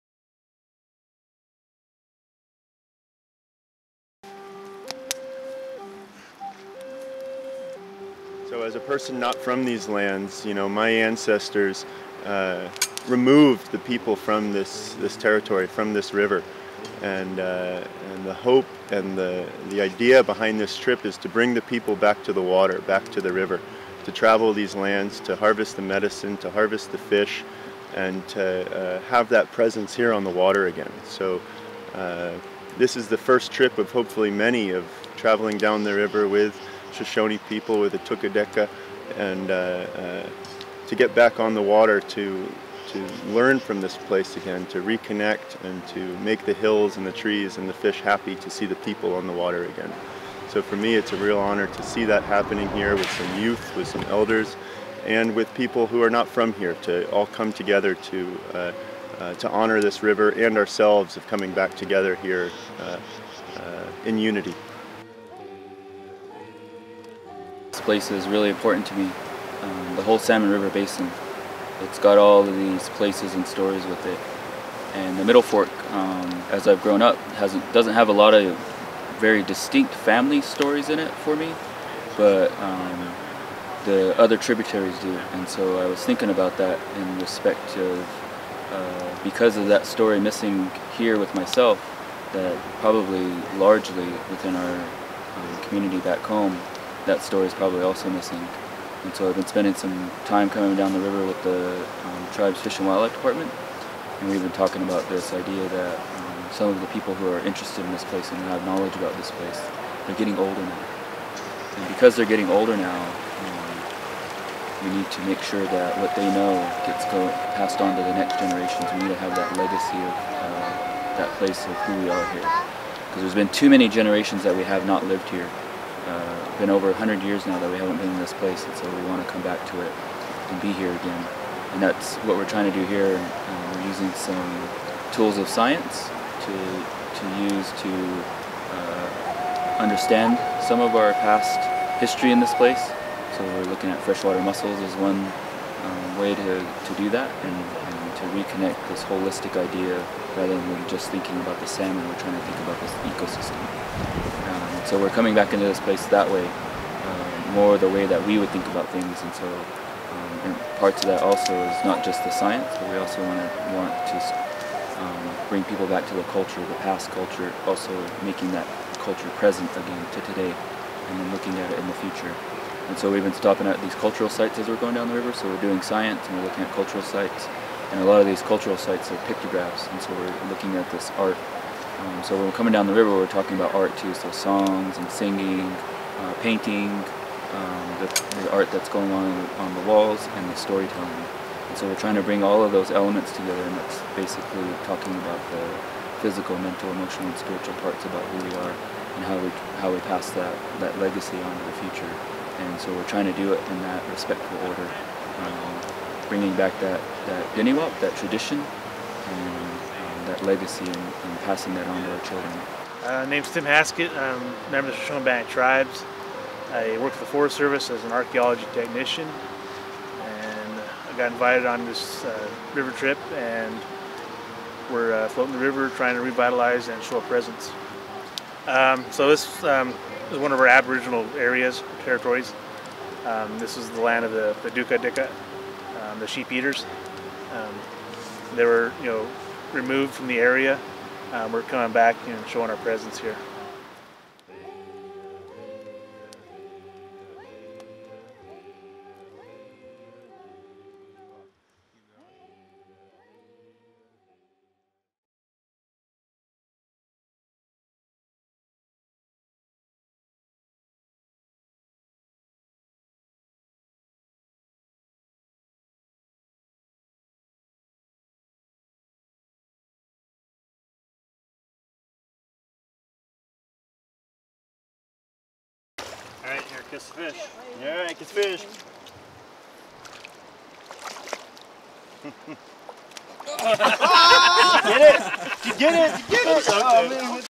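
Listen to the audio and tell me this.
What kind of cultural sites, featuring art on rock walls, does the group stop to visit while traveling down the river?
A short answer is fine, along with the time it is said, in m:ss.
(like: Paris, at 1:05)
Pictographs, at 2:59.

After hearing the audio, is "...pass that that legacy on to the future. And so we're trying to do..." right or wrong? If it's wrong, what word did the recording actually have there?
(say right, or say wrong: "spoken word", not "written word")
right.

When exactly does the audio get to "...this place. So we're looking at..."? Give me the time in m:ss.
2:22.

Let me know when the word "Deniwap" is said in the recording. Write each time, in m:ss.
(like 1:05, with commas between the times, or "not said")
3:27.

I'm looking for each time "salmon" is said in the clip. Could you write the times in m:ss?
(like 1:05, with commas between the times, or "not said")
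1:10, 2:31.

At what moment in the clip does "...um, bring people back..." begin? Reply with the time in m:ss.
2:44.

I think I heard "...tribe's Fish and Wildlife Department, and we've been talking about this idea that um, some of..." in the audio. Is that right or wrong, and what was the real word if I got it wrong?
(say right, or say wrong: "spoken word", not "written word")
right.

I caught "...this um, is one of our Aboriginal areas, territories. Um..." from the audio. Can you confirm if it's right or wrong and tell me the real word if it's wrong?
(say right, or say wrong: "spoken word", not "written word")
right.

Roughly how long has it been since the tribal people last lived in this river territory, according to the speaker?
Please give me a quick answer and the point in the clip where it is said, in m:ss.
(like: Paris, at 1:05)
Over 100 years, at 2:06.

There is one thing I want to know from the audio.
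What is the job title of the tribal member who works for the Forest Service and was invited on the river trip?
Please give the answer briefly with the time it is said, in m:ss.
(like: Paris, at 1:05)
Archaeology technician, at 3:38.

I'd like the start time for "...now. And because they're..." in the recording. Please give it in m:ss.
1:50.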